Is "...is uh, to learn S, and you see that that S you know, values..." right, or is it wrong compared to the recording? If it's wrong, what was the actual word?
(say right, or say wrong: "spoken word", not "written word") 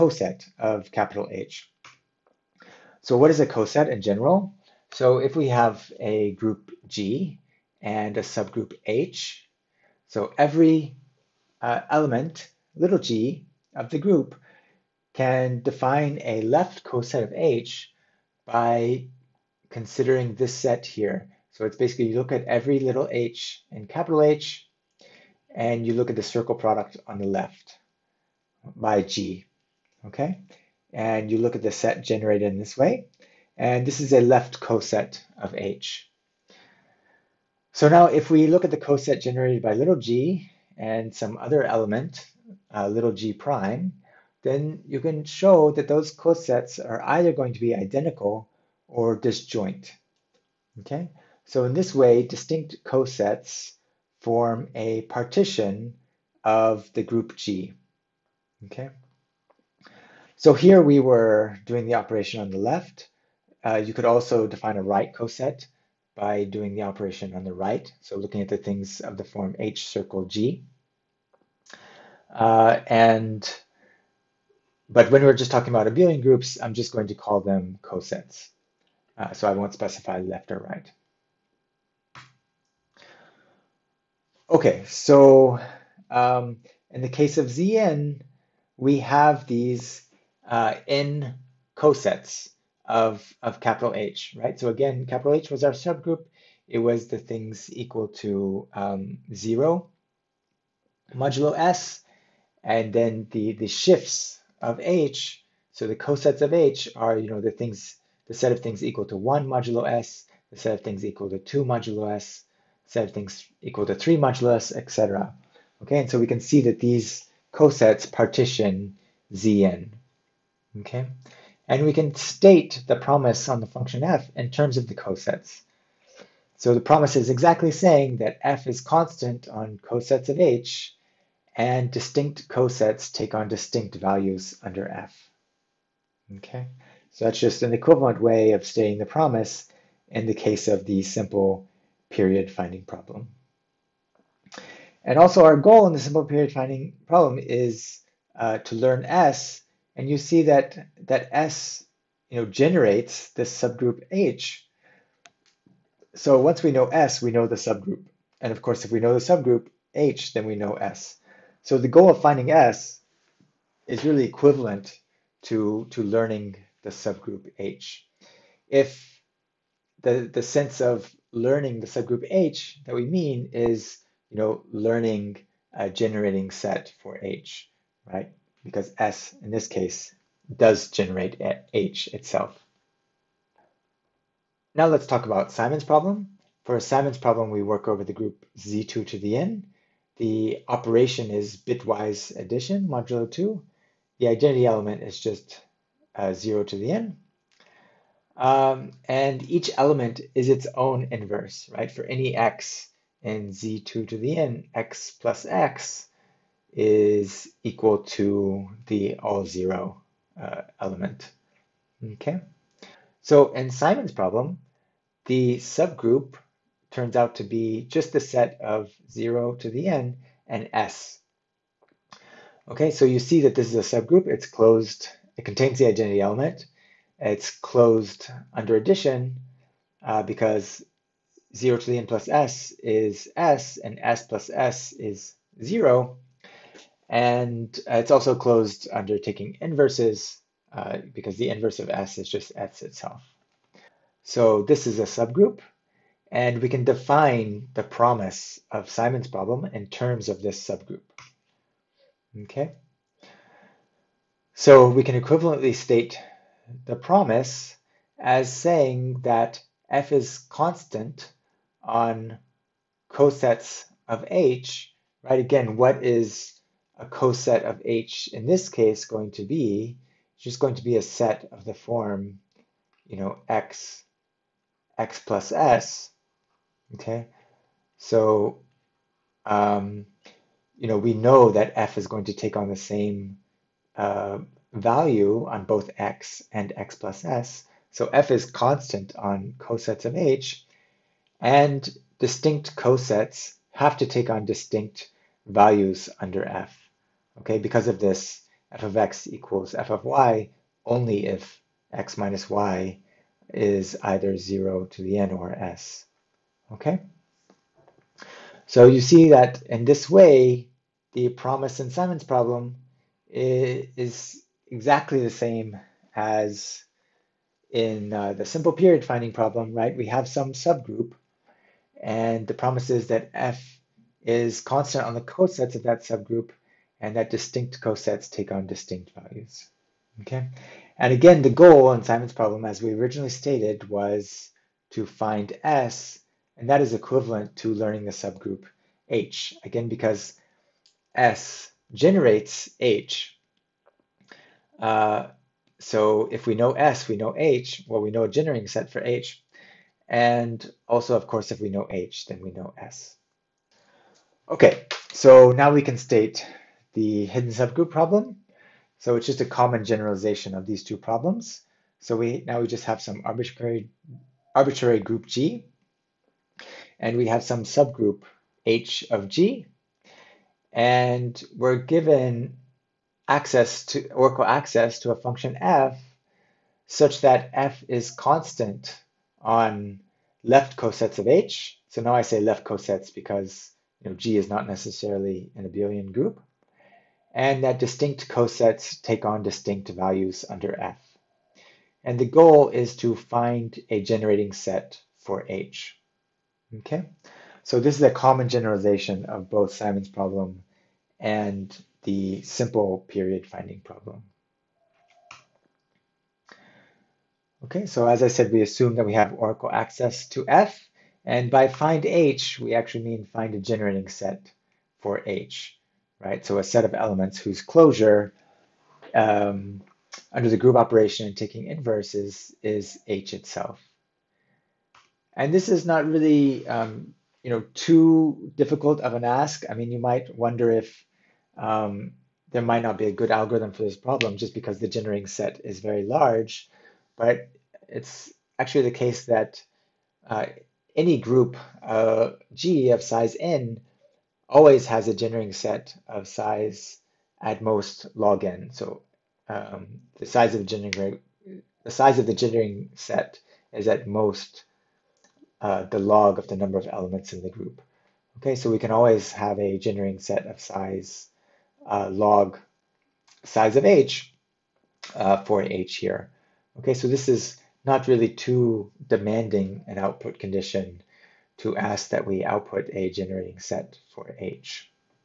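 wrong: "generates", not "values".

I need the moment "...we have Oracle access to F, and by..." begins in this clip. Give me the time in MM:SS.
06:49.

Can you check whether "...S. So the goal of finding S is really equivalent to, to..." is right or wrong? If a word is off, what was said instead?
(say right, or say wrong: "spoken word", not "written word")
right.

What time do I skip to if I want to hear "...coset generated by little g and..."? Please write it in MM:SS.
00:38.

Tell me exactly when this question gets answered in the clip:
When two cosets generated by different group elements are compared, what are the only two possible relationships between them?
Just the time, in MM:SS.
00:47.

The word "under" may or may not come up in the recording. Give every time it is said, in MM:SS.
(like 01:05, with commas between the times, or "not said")
02:14, 03:48, 03:58, 04:56, 06:30, 07:00.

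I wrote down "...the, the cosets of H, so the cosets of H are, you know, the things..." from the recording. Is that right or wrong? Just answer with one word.
wrong.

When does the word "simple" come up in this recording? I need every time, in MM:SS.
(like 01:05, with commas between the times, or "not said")
02:21, 02:25, 05:18, 06:42.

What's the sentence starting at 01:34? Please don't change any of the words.
So again, capital H was our subgroup.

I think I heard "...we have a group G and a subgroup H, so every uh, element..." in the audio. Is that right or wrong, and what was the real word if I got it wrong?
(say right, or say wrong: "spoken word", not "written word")
right.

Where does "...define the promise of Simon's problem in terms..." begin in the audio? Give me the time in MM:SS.
04:06.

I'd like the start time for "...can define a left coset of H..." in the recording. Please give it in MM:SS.
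00:15.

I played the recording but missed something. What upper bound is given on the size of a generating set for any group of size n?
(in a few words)
log n.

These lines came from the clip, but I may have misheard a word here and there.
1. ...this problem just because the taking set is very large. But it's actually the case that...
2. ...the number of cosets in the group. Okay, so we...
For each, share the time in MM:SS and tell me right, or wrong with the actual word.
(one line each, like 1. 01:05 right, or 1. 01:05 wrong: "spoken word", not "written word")
1. 07:13 wrong: "generating", not "taking"
2. 07:36 wrong: "elements", not "cosets".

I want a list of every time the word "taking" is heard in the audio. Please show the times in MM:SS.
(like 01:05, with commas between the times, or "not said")
03:59, 07:01.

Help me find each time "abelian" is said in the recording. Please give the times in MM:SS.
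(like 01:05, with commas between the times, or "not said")
01:15, 06:25.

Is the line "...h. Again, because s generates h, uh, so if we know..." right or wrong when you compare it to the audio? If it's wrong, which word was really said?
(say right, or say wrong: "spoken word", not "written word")
right.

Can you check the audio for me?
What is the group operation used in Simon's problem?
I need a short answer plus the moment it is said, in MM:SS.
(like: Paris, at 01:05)
bitwise addition modulo 2, at 03:11.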